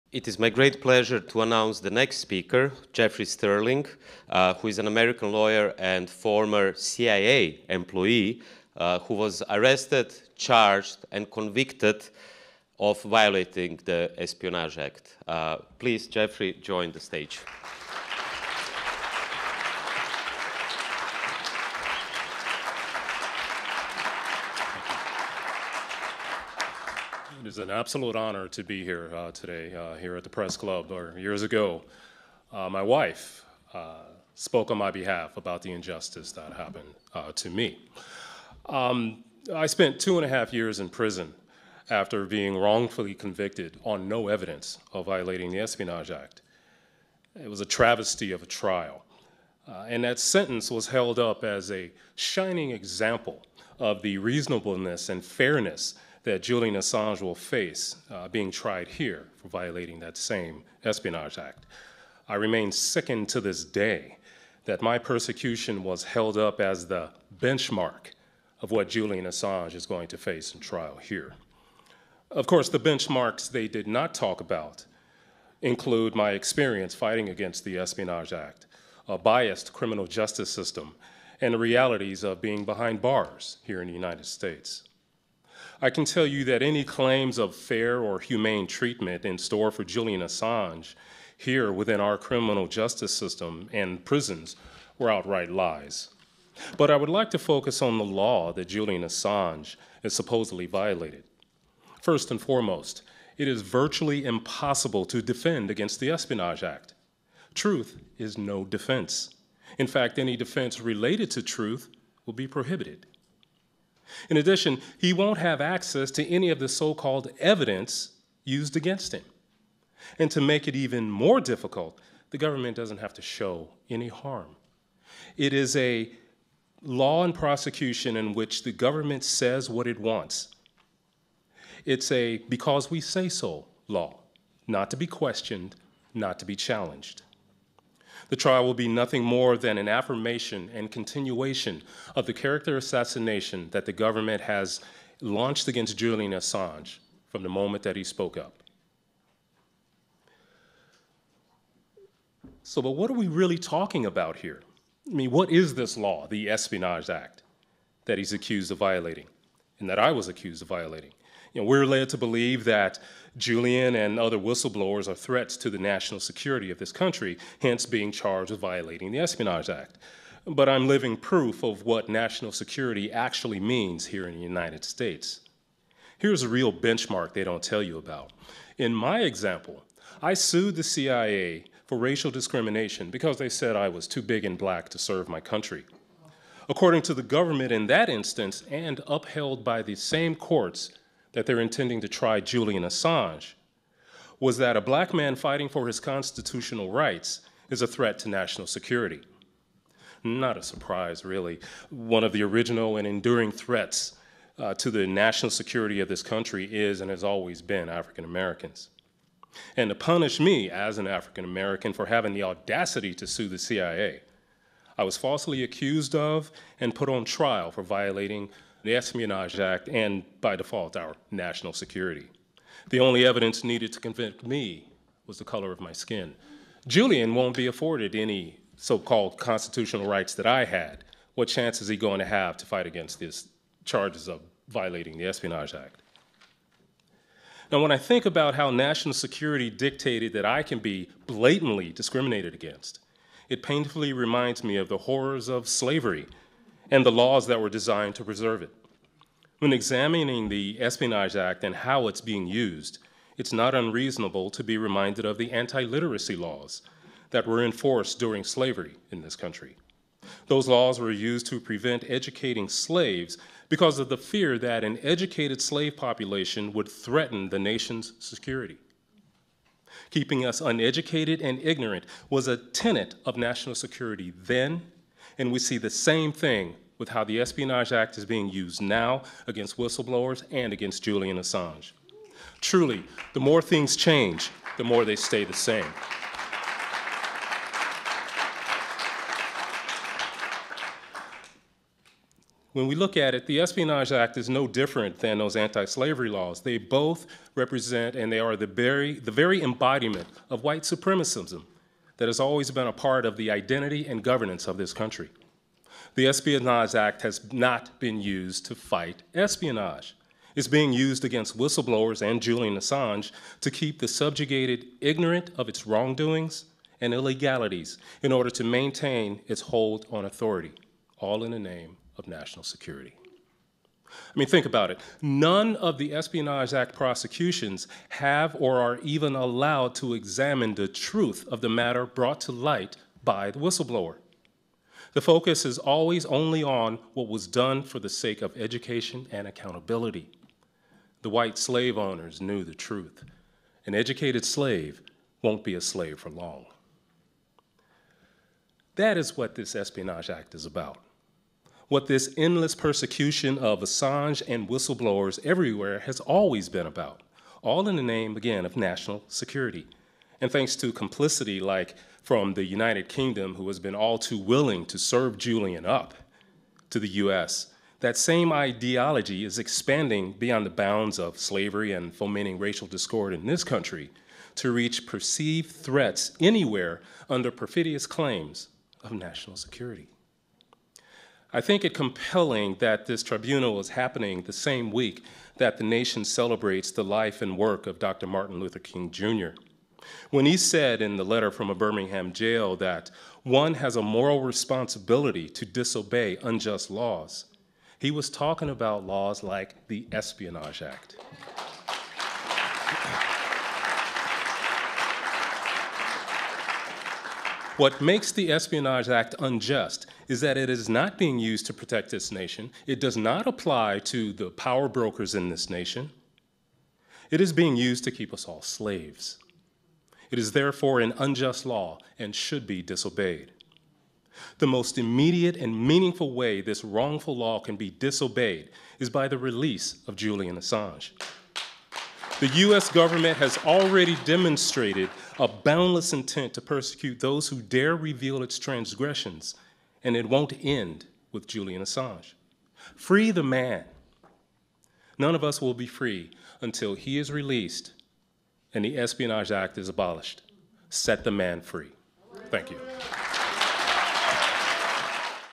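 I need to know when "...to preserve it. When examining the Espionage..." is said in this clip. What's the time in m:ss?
4:08.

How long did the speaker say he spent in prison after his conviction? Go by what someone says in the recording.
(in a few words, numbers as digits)
2.5 years.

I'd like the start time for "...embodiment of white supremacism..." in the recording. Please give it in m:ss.
4:59.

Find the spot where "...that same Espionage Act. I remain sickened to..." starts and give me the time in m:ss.
0:59.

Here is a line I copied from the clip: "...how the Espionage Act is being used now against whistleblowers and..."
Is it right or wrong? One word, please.
right.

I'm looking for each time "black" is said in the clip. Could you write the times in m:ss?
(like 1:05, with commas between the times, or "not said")
3:04, 3:14.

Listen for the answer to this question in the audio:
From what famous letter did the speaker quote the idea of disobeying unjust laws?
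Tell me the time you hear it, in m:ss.
6:31.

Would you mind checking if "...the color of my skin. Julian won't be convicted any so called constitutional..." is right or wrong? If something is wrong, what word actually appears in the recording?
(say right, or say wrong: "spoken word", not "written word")
wrong: "afforded", not "convicted".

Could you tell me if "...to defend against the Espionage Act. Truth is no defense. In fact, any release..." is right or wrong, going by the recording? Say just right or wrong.
wrong.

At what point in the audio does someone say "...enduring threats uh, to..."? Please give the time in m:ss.
3:23.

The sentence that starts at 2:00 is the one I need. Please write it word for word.
And to make it even more difficult, the government doesn't have to show any harm.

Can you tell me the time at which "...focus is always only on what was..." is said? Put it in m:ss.
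5:35.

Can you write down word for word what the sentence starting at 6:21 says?
I think it compelling that this tribunal is happening the same week that the nation celebrates the life and work of Dr.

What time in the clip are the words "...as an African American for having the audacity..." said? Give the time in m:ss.
3:30.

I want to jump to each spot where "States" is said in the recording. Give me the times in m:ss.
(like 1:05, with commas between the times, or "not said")
1:24, 2:54.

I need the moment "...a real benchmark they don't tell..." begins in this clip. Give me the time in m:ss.
2:56.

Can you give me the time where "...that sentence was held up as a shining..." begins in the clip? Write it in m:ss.
0:50.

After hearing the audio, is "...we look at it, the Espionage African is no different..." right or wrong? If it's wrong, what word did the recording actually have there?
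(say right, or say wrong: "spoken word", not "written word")
wrong: "Act", not "African".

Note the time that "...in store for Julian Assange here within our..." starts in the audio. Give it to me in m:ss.
1:29.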